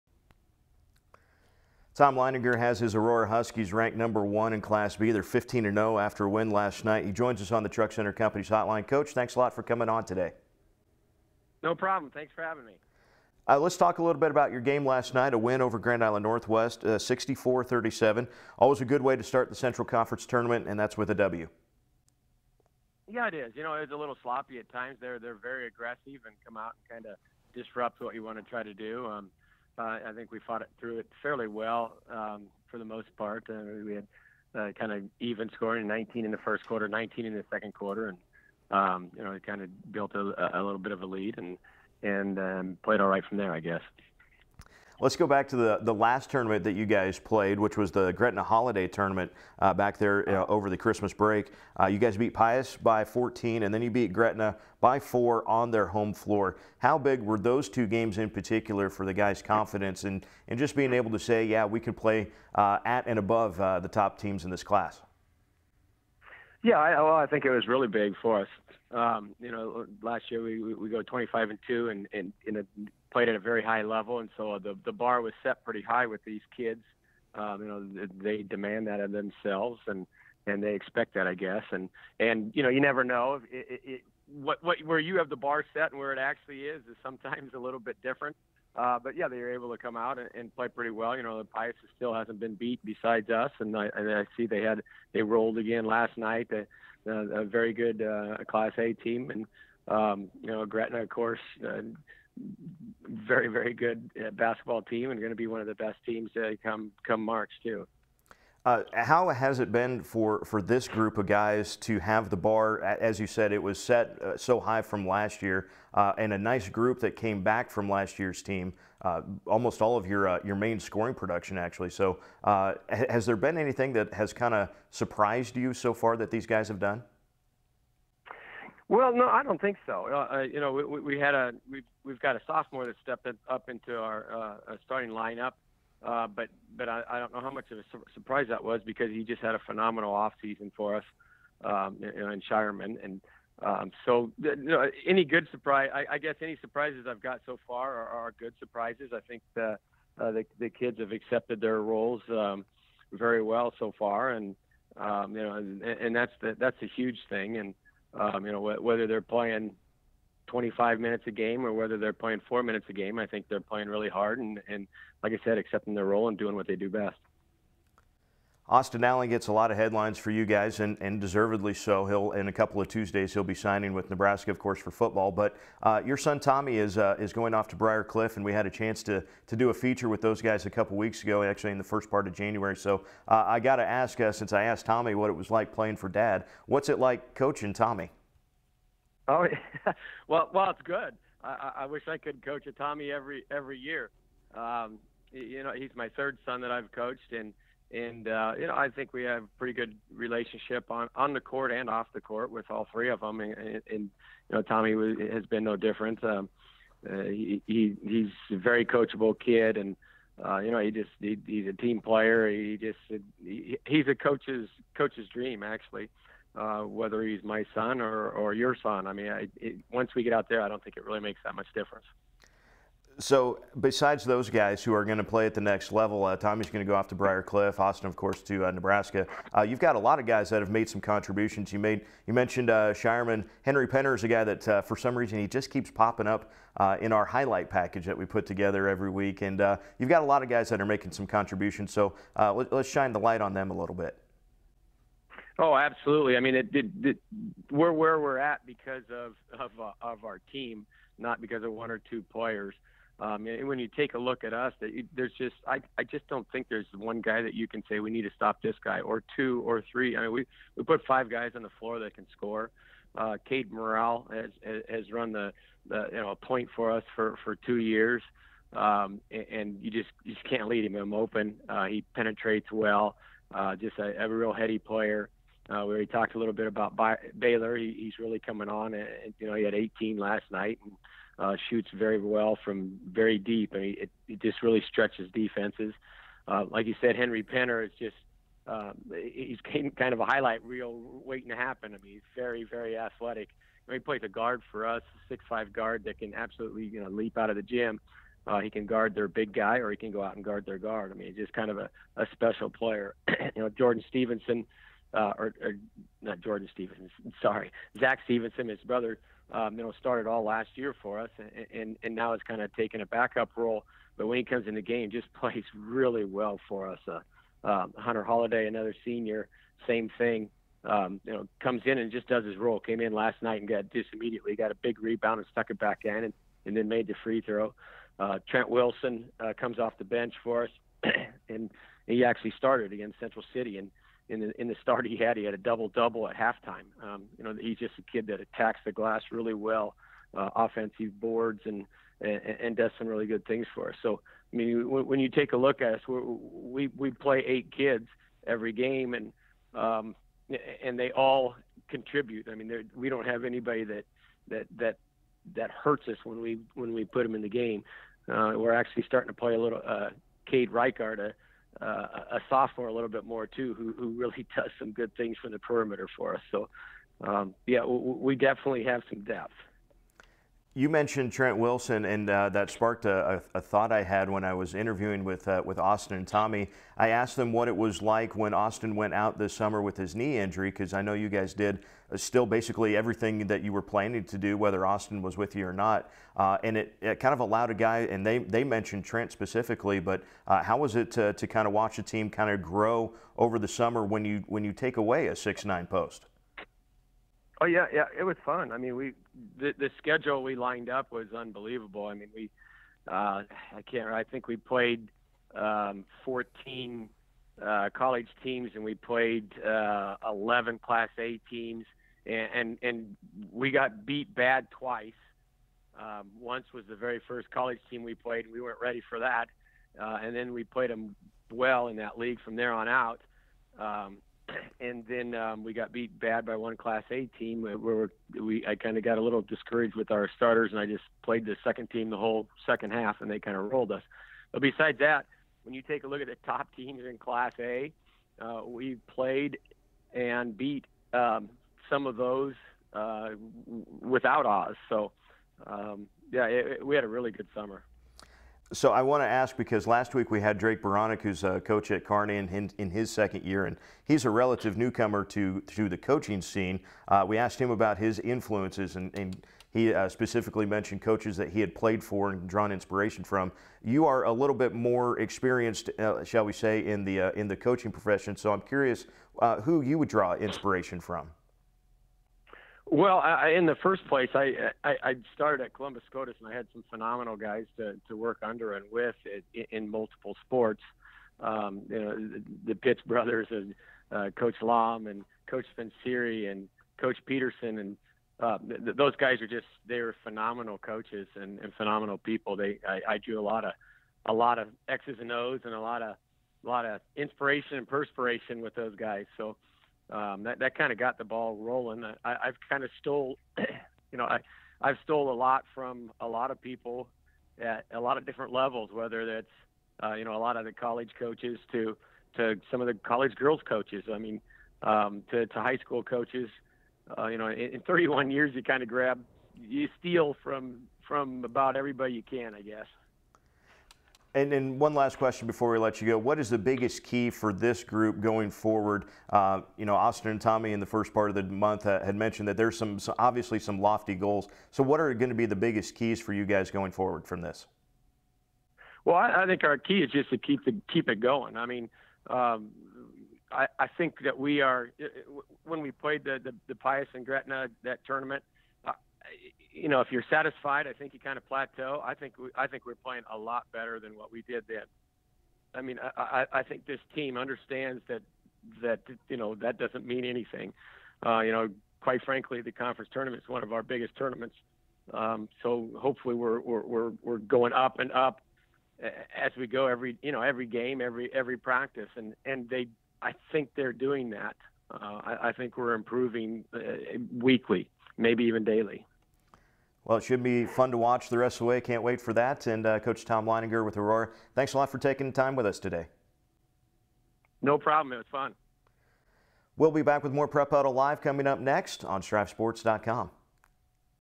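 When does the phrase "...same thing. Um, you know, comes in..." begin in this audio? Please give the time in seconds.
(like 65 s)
319 s.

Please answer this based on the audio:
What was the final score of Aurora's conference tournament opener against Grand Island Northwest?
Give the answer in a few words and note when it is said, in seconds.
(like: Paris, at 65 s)
64-37, at 16 s.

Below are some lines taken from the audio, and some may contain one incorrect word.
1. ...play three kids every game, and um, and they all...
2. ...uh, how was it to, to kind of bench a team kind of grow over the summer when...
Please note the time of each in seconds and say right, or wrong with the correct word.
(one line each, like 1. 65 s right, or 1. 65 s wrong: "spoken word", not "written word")
1. 347 s wrong: "eight", not "three"
2. 390 s wrong: "watch", not "bench".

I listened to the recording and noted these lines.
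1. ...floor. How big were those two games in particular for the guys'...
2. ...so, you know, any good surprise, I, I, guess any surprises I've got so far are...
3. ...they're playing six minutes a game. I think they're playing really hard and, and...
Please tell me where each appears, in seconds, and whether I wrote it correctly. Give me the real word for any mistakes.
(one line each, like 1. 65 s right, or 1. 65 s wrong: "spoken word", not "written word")
1. 56 s right
2. 144 s right
3. 161 s wrong: "four", not "six".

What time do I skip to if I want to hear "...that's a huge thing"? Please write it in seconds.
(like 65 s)
156 s.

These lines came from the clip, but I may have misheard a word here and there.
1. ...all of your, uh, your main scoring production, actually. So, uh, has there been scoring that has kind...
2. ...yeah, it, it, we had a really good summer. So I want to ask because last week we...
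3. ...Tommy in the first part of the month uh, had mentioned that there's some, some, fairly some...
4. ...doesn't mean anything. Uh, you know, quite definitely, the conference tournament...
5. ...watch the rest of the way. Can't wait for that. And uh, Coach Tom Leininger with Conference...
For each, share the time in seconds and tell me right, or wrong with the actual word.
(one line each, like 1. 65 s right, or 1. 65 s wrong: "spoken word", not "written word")
1. 119 s wrong: "anything", not "scoring"
2. 446 s right
3. 530 s wrong: "obviously", not "fairly"
4. 559 s wrong: "frankly", not "definitely"
5. 580 s wrong: "Aurora", not "Conference".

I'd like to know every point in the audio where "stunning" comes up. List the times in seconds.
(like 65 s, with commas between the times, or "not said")
not said.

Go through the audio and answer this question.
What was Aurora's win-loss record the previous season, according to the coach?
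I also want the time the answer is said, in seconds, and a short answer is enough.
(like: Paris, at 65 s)
25 and 2, at 71 s.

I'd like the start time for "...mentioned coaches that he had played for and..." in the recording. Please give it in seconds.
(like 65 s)
460 s.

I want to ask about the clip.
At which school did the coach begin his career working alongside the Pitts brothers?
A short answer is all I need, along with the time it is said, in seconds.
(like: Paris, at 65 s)
Columbus SCOTUS, at 475 s.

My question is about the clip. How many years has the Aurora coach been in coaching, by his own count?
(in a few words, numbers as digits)
31.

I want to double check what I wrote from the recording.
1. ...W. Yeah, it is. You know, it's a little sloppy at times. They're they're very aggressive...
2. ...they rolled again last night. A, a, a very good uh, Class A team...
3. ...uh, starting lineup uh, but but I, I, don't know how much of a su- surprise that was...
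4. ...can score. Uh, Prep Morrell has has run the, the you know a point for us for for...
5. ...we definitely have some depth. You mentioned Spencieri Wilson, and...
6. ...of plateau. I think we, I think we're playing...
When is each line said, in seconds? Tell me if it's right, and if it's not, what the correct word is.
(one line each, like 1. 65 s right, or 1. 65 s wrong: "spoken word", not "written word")
1. 21 s right
2. 95 s right
3. 134 s right
4. 262 s wrong: "Cade", not "Prep"
5. 368 s wrong: "Trent", not "Spencieri"
6. 551 s right.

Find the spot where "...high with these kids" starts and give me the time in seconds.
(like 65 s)
75 s.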